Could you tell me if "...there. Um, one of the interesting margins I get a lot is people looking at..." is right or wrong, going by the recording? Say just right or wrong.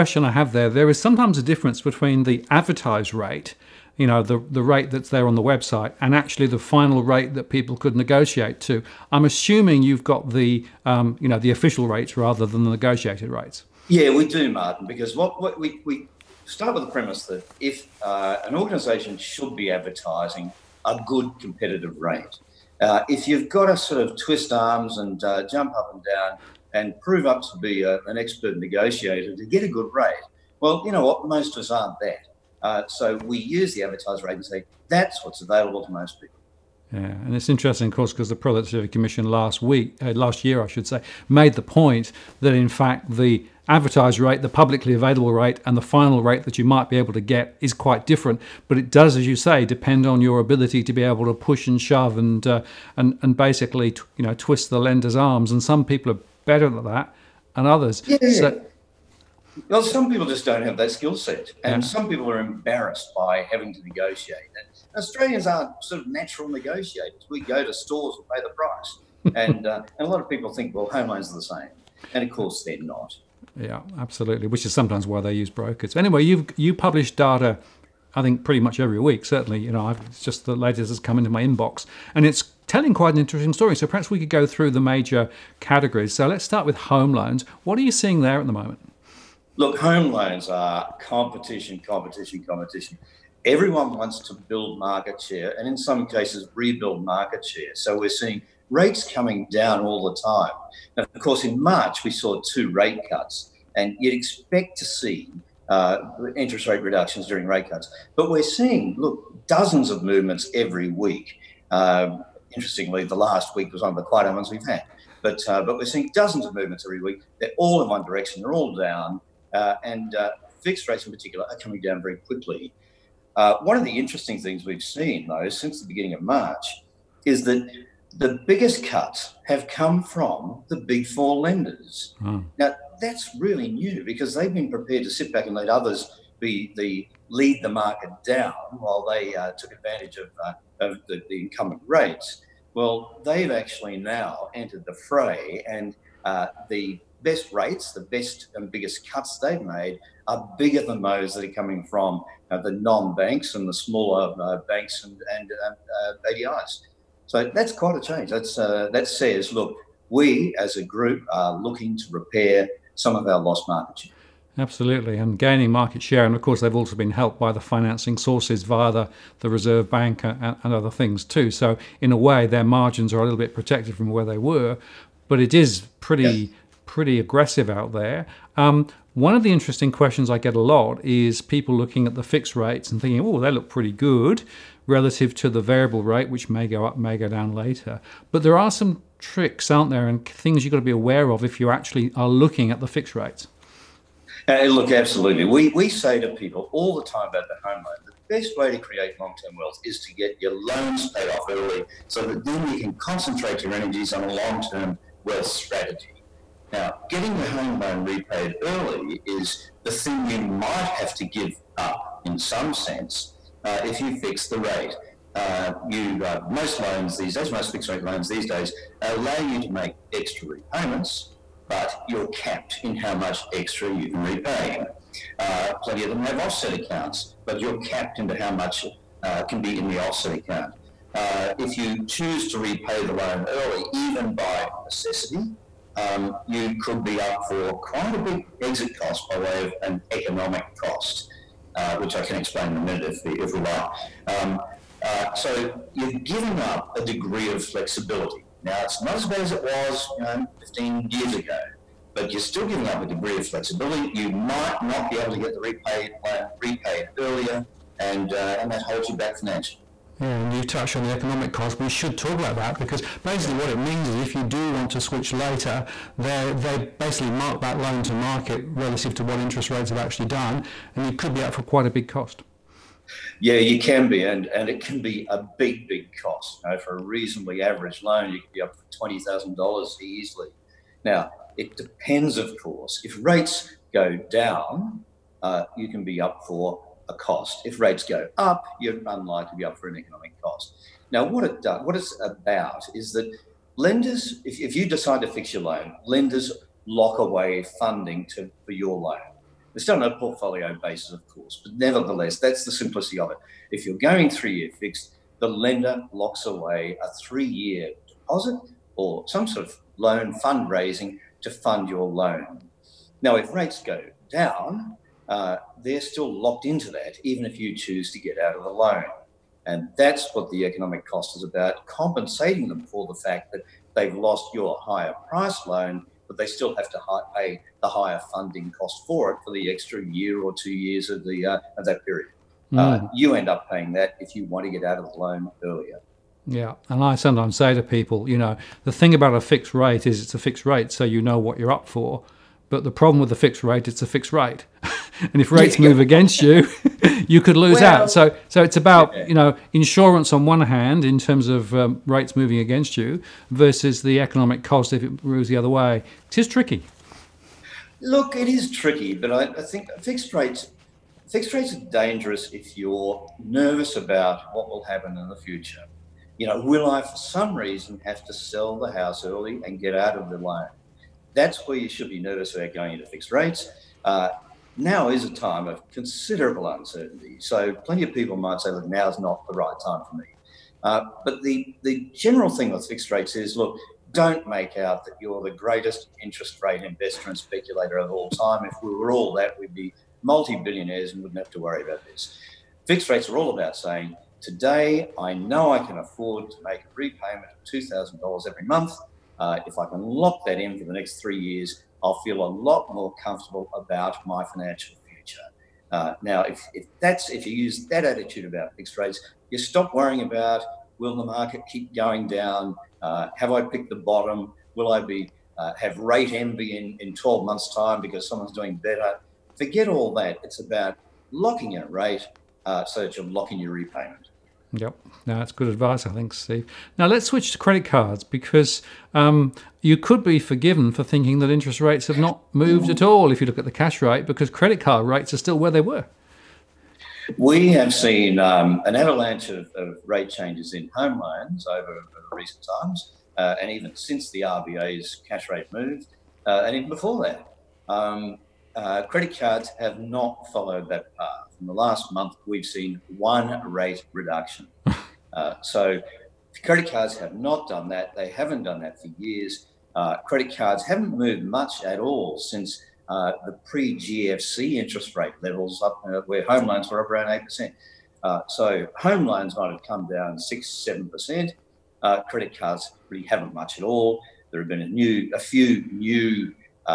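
wrong.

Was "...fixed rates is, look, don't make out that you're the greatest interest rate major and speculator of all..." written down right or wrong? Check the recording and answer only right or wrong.
wrong.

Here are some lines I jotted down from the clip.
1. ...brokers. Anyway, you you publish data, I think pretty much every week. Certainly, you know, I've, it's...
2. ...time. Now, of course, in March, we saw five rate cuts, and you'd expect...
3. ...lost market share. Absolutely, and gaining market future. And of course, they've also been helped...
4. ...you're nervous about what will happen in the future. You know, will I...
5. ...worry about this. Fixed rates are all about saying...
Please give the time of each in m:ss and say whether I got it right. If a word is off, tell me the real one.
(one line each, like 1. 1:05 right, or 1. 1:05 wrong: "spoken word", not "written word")
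1. 1:15 right
2. 1:40 wrong: "two", not "five"
3. 2:43 wrong: "share", not "future"
4. 6:02 right
5. 6:31 right.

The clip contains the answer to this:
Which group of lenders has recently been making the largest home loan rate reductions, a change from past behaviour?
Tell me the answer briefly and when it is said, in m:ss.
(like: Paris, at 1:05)
big four lenders, at 2:10.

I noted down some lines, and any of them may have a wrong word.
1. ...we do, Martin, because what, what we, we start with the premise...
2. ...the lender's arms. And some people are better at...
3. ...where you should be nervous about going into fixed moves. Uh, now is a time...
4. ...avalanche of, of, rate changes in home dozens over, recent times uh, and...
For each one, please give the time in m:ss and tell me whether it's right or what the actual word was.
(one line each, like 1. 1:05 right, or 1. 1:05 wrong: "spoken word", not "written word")
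1. 0:14 right
2. 0:54 right
3. 6:11 wrong: "rates", not "moves"
4. 7:18 wrong: "loans", not "dozens".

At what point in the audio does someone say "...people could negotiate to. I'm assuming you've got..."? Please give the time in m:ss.
0:07.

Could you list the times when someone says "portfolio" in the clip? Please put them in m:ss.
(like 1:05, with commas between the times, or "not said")
5:00.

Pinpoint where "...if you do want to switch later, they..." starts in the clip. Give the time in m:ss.
4:24.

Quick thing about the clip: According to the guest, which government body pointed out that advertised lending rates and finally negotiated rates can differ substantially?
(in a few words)
Productivity Commission.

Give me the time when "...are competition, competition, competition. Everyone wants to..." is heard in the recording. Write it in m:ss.
1:30.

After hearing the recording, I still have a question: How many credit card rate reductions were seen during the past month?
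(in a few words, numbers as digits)
1.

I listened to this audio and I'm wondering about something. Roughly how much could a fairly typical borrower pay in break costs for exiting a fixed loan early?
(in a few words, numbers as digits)
$20,000.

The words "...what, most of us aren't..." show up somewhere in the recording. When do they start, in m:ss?
0:31.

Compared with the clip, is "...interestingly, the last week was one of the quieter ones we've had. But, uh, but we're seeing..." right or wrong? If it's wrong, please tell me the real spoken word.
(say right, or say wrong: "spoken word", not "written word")
right.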